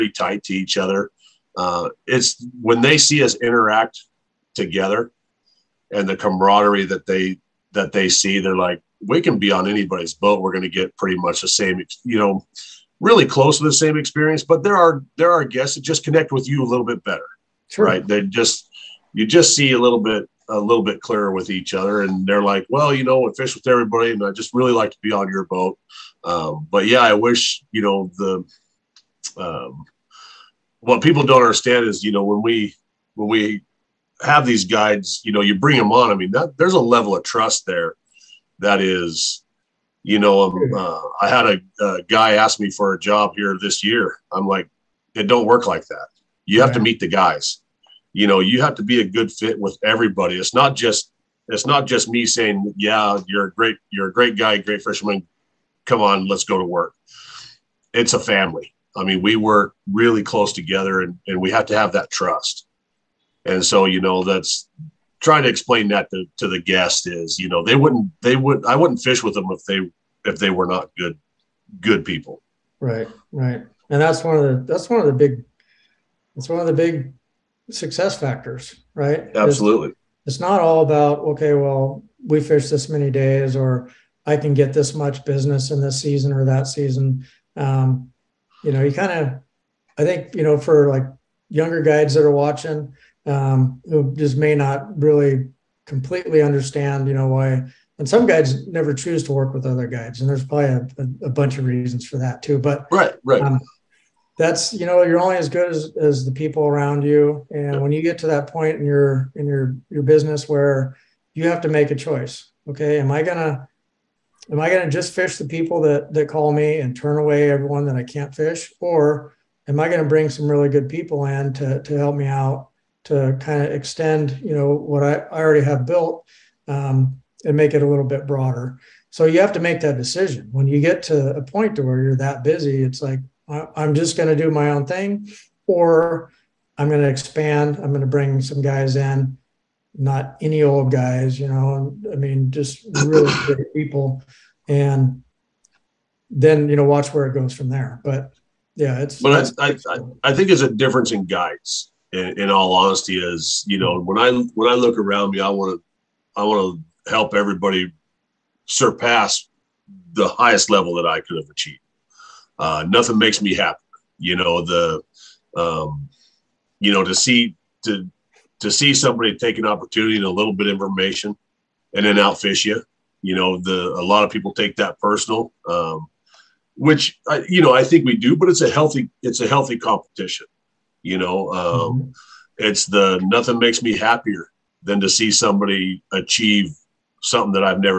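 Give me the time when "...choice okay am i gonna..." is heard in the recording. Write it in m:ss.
1:51.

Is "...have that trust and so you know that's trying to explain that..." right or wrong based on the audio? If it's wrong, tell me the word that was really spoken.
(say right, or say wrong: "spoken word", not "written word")
right.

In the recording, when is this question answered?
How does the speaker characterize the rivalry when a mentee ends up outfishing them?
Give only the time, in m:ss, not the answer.
2:59.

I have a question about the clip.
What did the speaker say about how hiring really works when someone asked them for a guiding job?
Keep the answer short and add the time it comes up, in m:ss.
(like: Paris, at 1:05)
it don't work like that, at 0:45.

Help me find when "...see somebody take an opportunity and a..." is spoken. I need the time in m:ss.
2:48.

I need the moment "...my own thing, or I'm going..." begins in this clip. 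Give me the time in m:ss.
2:14.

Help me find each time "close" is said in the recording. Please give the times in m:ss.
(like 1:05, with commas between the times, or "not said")
0:13, 1:00.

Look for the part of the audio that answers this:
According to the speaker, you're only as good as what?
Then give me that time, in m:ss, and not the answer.
1:46.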